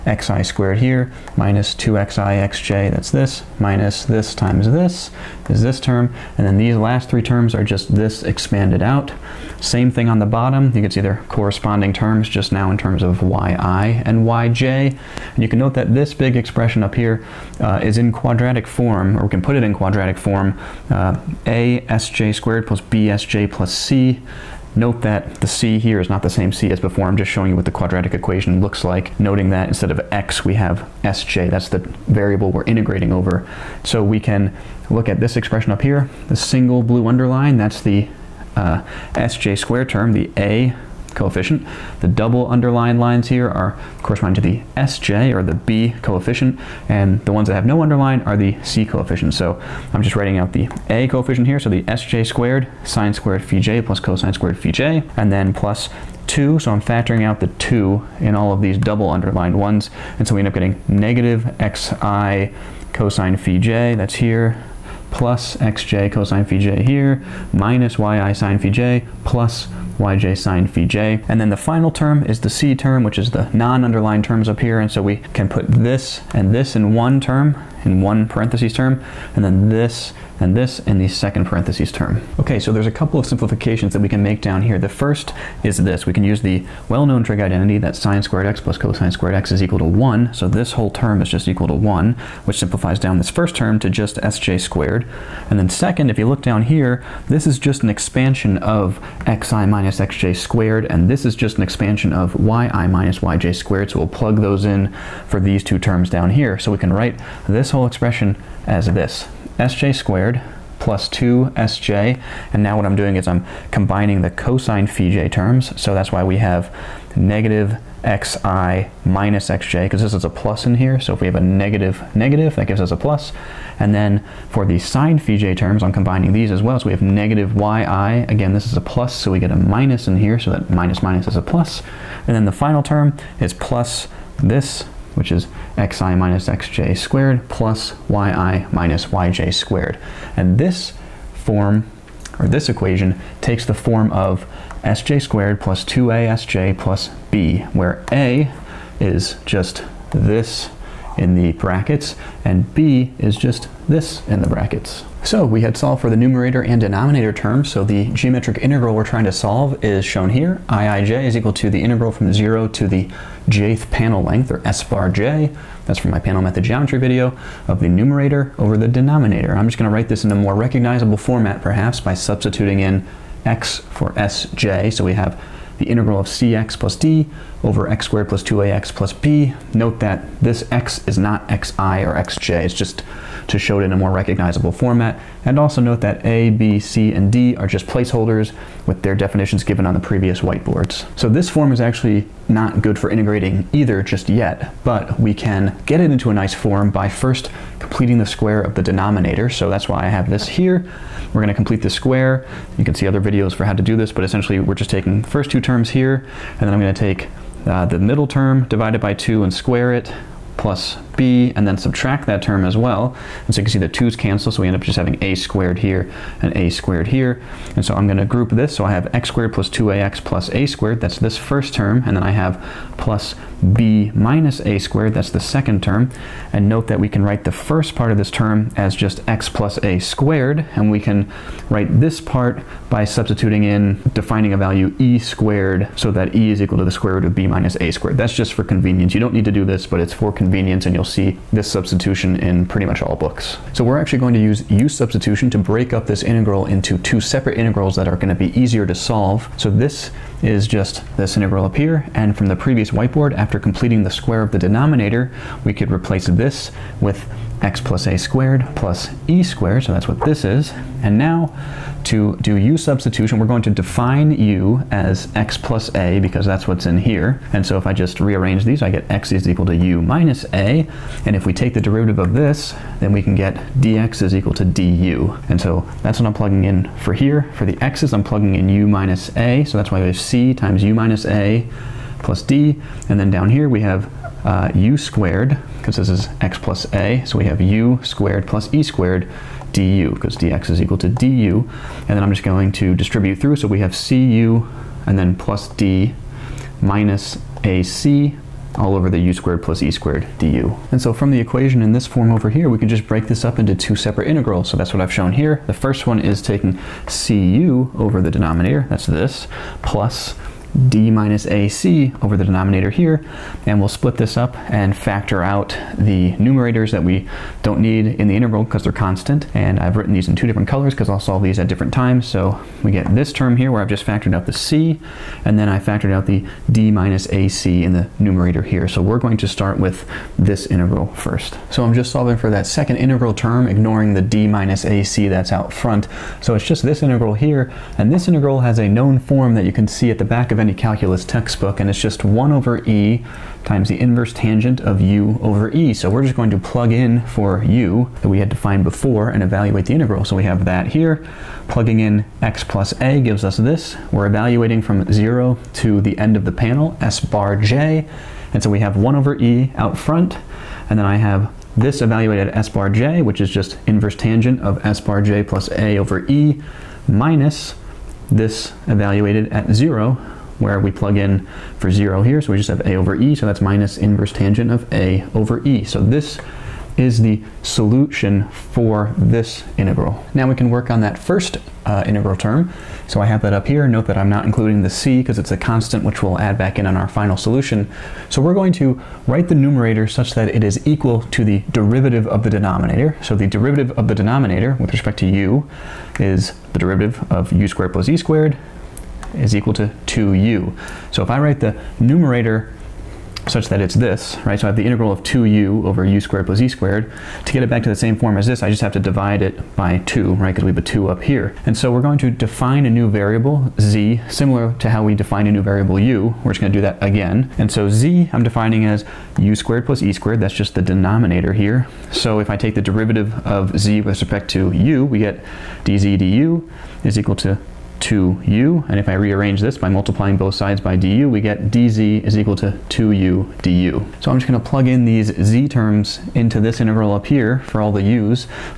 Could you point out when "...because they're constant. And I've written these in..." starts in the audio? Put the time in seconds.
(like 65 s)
318 s.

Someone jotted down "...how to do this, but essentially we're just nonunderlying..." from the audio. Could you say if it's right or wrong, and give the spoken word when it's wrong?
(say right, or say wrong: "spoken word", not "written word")
wrong: "taking", not "nonunderlying".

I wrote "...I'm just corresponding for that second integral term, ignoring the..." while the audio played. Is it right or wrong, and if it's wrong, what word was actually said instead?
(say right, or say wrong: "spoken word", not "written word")
wrong: "solving", not "corresponding".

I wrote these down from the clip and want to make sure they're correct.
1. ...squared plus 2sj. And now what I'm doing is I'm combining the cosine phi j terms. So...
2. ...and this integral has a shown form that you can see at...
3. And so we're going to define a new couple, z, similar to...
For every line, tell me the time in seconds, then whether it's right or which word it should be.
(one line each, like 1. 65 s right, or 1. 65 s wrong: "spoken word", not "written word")
1. 109 s right
2. 337 s wrong: "known", not "shown"
3. 411 s wrong: "variable", not "couple".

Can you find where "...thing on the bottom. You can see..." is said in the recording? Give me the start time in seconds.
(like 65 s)
9 s.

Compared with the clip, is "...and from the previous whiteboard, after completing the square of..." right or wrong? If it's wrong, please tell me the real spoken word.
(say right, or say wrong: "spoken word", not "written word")
right.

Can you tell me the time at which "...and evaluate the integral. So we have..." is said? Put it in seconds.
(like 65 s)
349 s.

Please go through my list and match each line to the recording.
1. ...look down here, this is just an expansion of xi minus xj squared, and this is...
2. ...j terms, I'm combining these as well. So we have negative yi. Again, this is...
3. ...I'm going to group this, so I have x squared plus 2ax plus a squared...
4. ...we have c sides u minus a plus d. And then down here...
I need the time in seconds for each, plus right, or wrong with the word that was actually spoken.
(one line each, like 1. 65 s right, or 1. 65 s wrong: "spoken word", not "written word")
1. 96 s right
2. 125 s right
3. 217 s right
4. 279 s wrong: "times", not "sides".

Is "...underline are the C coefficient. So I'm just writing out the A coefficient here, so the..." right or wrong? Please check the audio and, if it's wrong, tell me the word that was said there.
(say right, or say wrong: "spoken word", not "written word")
right.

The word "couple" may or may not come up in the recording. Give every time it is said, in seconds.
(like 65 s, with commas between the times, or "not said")
82 s.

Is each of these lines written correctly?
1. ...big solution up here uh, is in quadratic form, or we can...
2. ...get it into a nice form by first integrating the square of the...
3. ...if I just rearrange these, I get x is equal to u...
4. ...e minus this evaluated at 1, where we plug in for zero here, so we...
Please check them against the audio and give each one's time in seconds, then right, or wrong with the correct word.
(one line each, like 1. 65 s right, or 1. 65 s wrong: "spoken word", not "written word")
1. 16 s wrong: "expression", not "solution"
2. 195 s wrong: "completing", not "integrating"
3. 267 s right
4. 366 s wrong: "0", not "1".